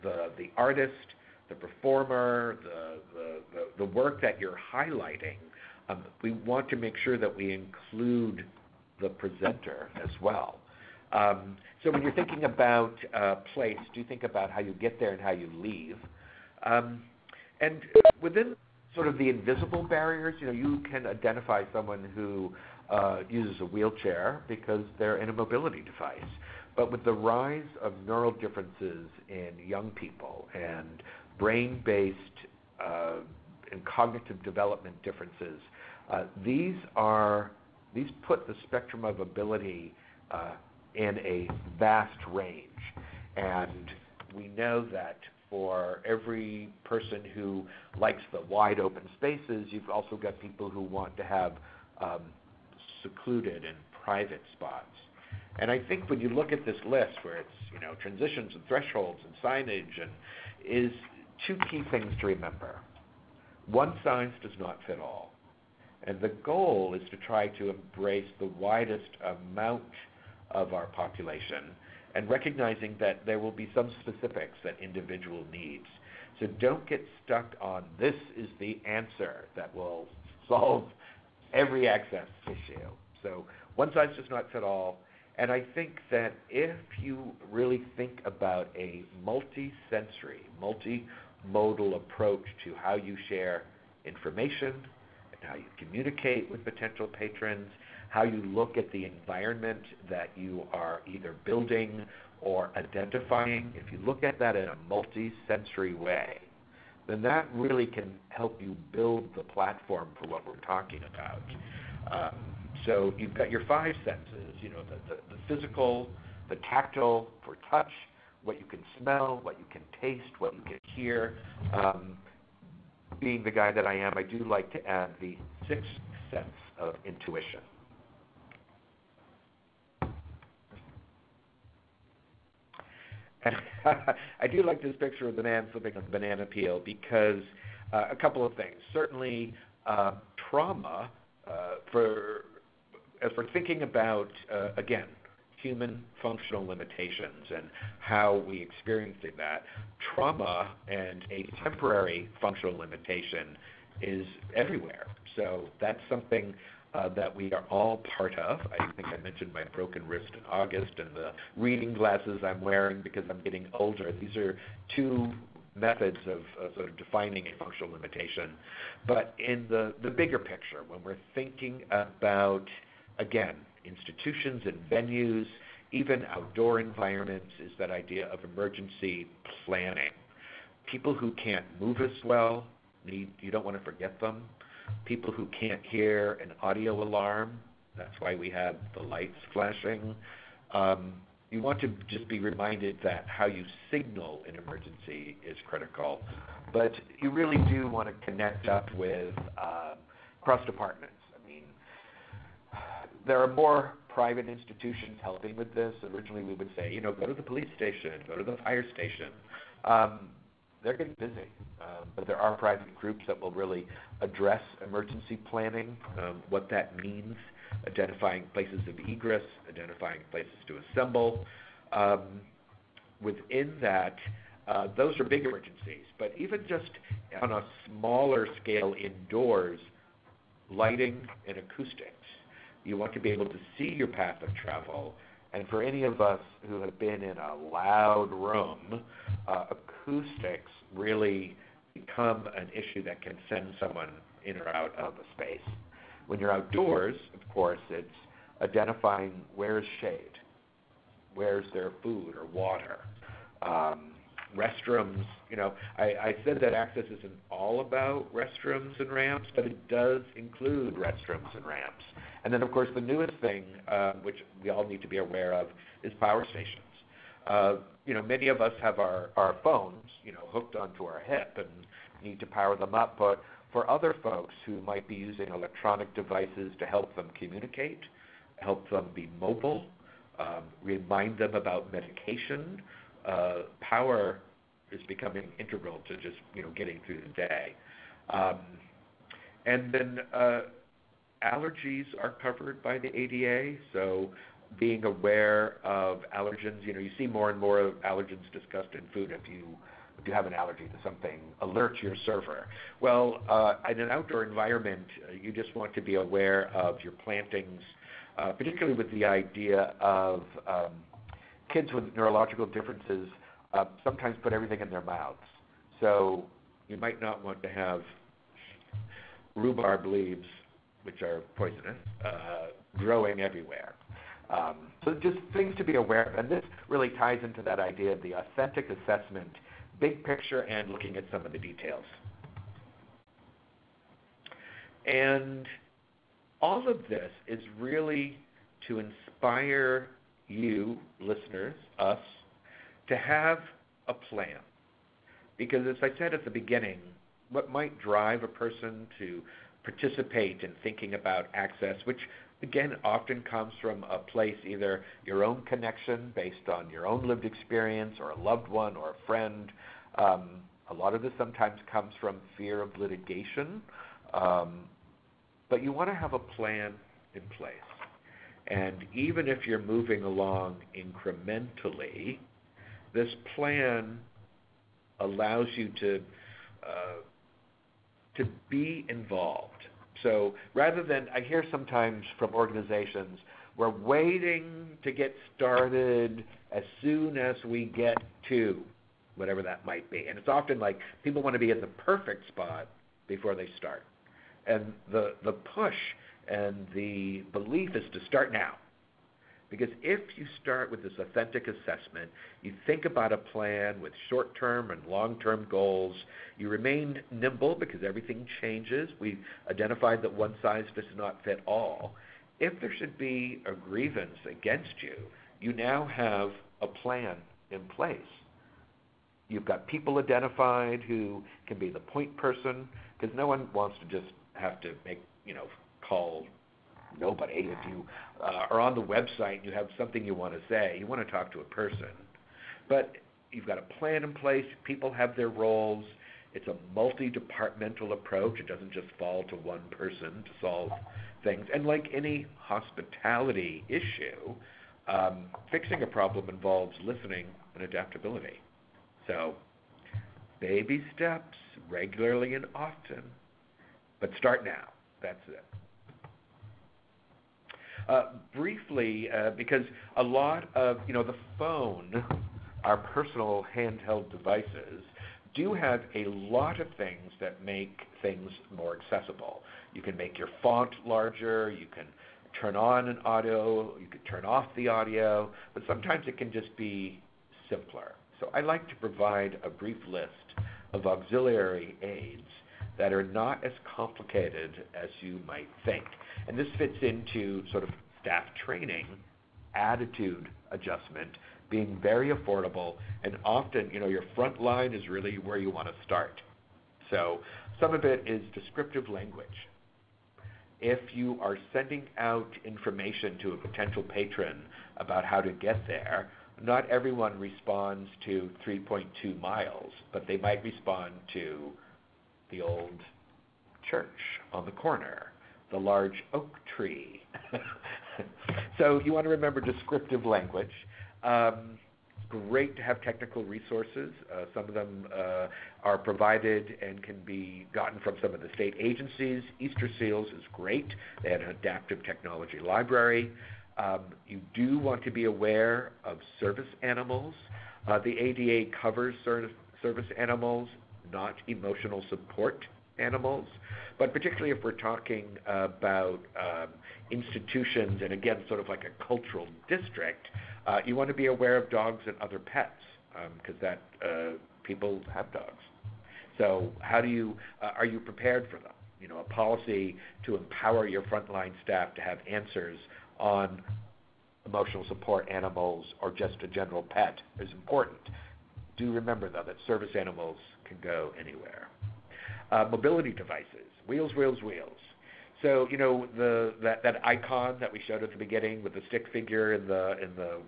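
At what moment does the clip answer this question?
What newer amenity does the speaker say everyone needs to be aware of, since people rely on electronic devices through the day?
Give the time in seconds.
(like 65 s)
266 s.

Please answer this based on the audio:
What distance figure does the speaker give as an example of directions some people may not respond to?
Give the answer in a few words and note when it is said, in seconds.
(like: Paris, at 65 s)
3.2 miles, at 508 s.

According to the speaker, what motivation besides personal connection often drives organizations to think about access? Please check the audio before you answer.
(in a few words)
Fear of litigation.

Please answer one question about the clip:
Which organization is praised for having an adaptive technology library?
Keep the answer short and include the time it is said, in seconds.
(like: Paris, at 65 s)
Easter Seals, at 529 s.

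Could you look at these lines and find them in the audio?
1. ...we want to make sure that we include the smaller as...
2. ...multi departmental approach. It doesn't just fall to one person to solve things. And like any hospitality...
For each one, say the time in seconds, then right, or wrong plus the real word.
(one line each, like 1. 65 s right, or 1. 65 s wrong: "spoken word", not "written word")
1. 6 s wrong: "presenter", not "smaller"
2. 436 s right.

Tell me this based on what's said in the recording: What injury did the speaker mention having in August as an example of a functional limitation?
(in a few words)
Broken wrist.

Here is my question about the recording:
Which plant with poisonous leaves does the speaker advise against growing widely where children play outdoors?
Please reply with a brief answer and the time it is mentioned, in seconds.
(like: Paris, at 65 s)
Rhubarb, at 319 s.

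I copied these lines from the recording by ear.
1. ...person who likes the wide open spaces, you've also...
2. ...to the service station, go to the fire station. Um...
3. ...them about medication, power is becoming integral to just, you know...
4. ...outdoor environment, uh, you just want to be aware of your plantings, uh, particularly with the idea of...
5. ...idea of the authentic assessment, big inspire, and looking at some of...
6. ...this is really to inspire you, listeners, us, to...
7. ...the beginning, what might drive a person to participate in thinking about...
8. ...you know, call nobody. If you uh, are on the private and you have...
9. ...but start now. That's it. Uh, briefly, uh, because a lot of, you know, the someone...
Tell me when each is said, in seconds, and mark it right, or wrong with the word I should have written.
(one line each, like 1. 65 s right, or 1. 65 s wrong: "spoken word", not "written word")
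1. 46 s right
2. 207 s wrong: "police", not "service"
3. 281 s right
4. 304 s right
5. 327 s wrong: "picture", not "inspire"
6. 337 s right
7. 346 s right
8. 425 s wrong: "website", not "private"
9. 454 s wrong: "phone", not "someone".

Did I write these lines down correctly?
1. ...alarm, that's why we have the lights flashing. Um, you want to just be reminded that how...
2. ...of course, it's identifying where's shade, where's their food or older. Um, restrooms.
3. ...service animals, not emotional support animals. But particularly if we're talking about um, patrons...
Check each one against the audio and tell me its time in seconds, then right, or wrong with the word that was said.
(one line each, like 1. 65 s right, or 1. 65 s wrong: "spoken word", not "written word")
1. 187 s right
2. 247 s wrong: "water", not "older"
3. 539 s wrong: "institutions", not "patrons".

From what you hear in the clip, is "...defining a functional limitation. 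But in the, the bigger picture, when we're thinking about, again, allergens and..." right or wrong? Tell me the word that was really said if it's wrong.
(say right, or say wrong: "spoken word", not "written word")
wrong: "institutions", not "allergens".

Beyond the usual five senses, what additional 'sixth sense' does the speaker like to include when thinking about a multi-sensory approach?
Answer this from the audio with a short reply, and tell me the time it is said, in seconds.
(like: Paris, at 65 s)
Intuition, at 127 s.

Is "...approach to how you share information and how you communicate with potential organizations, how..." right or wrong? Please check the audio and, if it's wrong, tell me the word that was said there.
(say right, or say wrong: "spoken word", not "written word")
wrong: "patrons", not "organizations".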